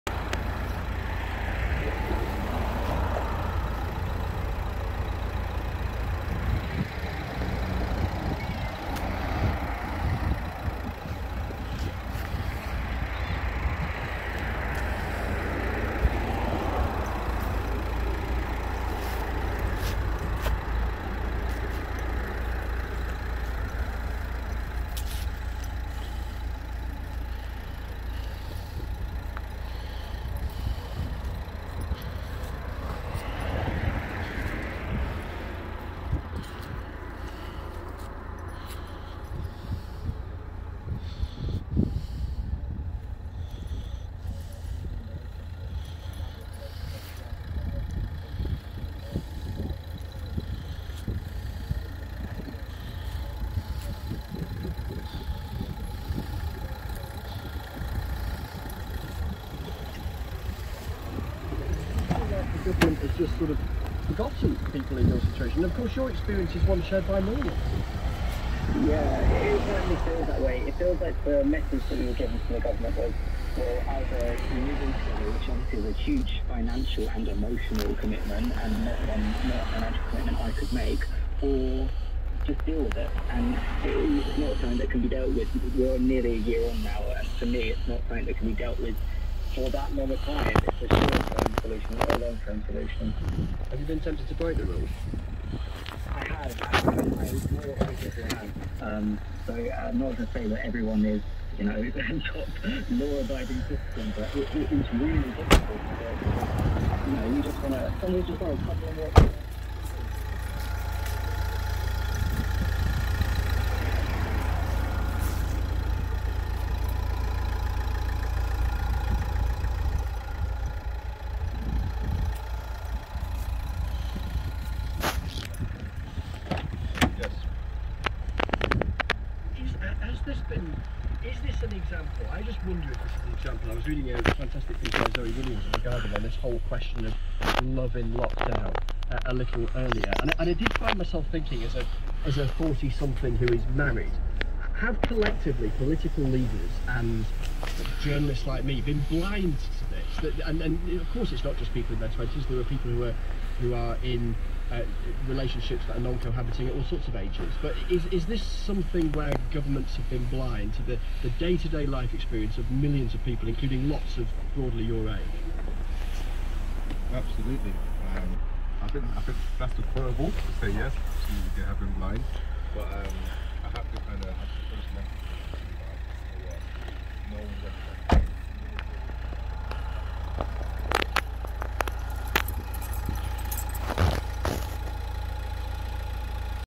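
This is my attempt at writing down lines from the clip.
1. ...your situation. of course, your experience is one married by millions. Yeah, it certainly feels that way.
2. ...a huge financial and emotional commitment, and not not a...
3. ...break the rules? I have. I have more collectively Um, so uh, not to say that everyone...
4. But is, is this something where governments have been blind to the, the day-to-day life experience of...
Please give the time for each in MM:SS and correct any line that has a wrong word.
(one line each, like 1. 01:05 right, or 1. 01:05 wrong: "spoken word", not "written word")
1. 01:05 wrong: "shared", not "married"
2. 01:15 right
3. 01:34 wrong: "obviously", not "collectively"
4. 02:37 right.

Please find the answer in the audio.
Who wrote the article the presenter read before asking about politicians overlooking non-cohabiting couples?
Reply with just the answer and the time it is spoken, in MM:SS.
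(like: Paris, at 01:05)
Zoe Williams, at 02:15.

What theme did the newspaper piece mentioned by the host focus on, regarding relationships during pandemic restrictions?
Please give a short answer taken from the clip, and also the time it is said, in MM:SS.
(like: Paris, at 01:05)
love in lockdown, at 02:17.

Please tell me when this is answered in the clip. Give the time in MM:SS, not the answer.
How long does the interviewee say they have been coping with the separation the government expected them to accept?
01:25.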